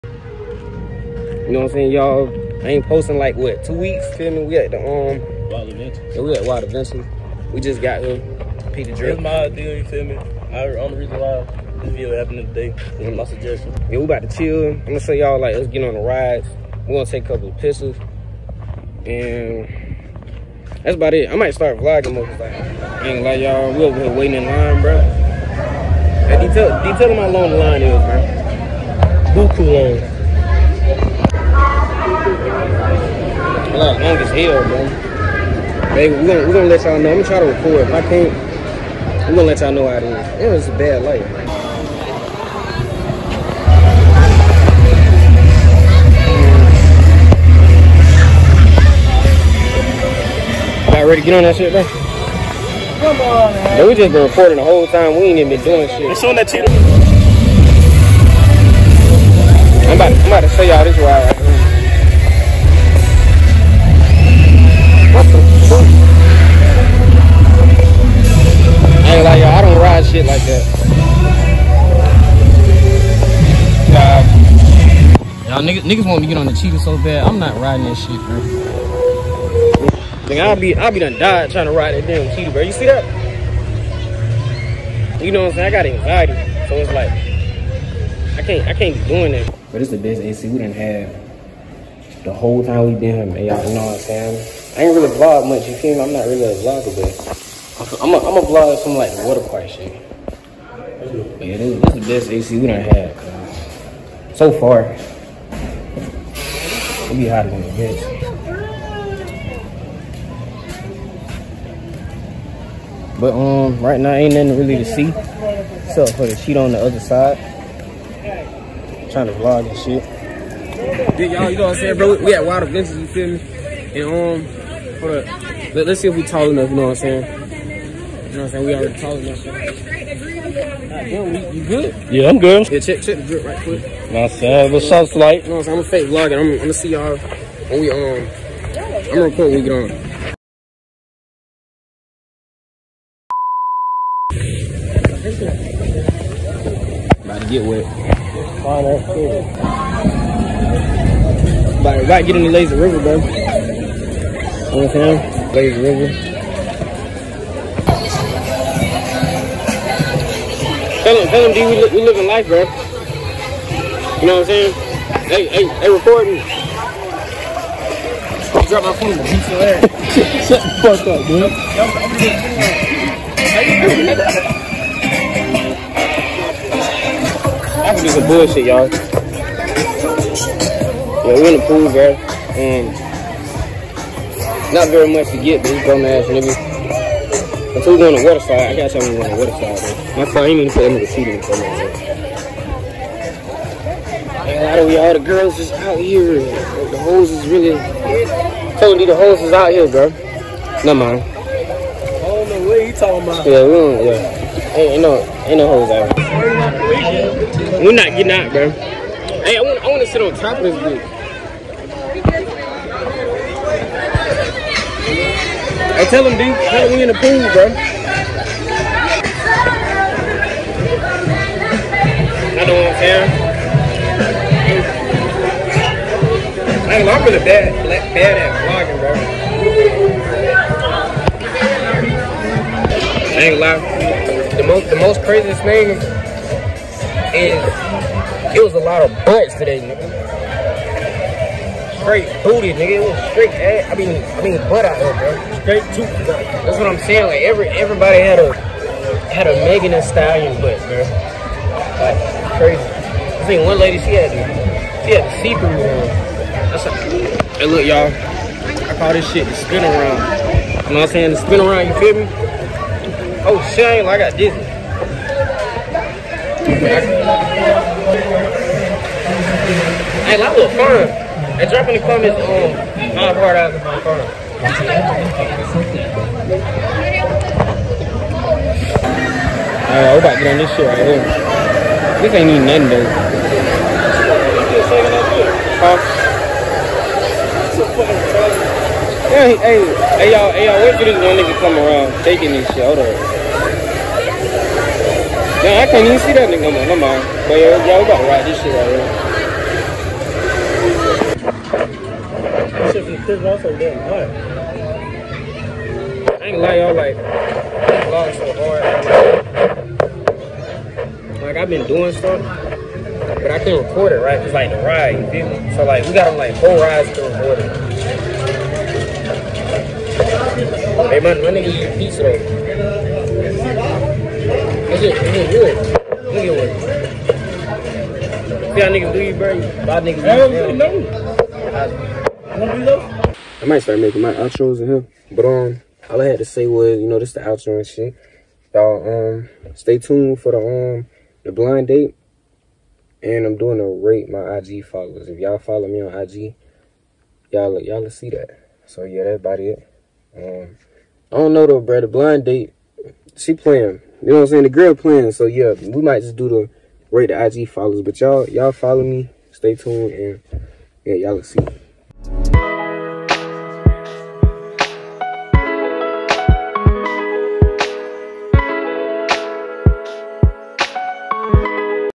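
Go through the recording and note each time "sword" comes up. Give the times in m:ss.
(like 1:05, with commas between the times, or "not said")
not said.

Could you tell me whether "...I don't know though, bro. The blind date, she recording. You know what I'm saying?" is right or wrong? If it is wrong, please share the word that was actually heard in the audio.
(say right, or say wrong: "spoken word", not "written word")
wrong: "playing", not "recording".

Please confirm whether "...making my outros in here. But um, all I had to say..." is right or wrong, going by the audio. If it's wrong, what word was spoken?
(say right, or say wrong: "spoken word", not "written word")
right.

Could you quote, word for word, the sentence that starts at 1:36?
I'm not really a vlogger, but I'm a, I'm a vlog some like water park shit.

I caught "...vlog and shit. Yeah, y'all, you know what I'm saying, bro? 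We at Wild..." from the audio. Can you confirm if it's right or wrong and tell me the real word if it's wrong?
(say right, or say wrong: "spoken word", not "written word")
right.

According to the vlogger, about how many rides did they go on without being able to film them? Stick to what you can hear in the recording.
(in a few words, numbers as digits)
4.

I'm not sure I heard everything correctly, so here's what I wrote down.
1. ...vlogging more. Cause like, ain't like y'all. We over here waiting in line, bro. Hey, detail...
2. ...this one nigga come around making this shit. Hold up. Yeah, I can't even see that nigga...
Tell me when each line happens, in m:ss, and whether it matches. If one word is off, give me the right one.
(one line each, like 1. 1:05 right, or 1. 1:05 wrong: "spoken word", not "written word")
1. 0:21 right
2. 4:51 wrong: "taking", not "making".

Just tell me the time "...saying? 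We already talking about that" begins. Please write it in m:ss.
2:08.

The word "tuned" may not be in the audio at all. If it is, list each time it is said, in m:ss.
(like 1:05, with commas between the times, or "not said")
5:39, 5:59.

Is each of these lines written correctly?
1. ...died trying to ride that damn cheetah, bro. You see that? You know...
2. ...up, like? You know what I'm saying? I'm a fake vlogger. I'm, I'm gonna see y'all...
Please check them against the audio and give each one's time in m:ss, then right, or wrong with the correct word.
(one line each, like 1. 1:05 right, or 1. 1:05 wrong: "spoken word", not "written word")
1. 1:21 right
2. 2:14 right.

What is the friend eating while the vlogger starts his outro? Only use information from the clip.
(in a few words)
pizza.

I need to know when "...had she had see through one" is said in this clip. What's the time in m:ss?
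4:14.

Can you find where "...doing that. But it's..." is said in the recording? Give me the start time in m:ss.
1:29.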